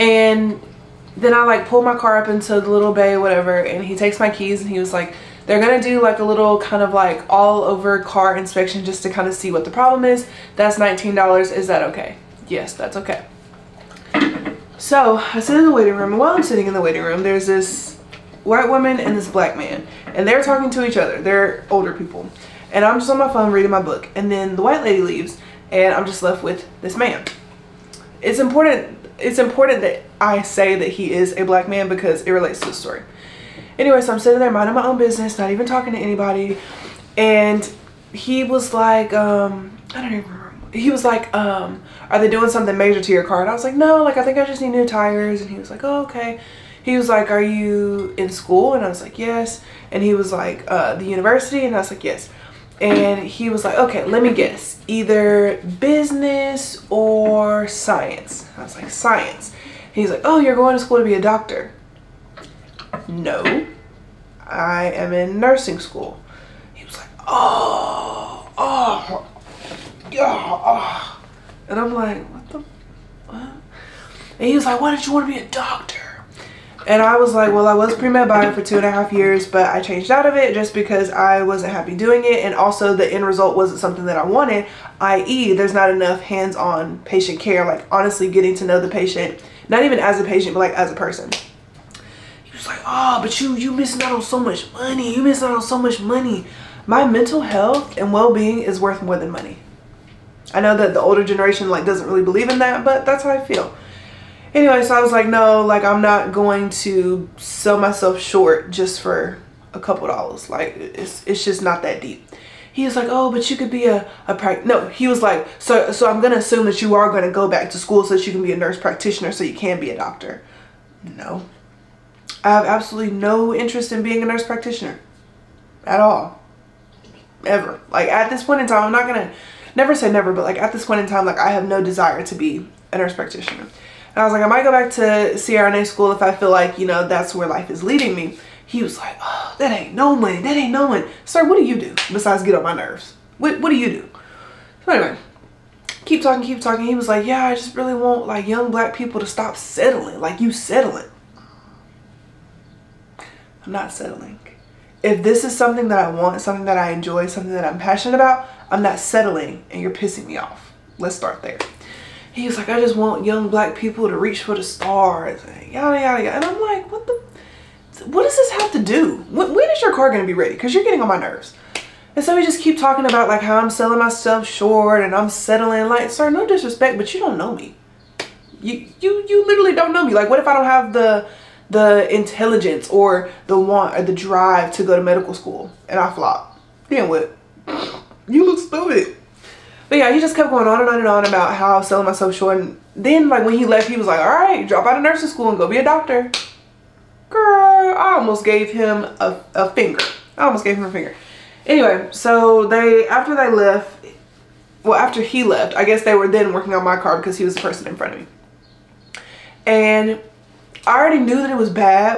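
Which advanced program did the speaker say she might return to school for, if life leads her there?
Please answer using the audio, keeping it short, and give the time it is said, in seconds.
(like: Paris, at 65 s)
CRNA school, at 135 s.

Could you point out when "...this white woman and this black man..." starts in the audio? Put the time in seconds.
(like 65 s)
17 s.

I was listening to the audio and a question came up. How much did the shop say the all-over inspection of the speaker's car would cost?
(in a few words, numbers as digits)
$19.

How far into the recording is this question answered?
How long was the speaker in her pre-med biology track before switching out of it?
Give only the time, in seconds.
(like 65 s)
78 s.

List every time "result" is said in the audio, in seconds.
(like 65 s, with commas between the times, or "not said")
83 s.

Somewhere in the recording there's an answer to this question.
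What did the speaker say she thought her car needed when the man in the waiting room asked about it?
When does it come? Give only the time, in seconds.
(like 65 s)
44 s.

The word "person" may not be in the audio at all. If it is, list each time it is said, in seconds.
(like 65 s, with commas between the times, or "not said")
90 s, 207 s.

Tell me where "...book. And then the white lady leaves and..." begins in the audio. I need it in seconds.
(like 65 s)
23 s.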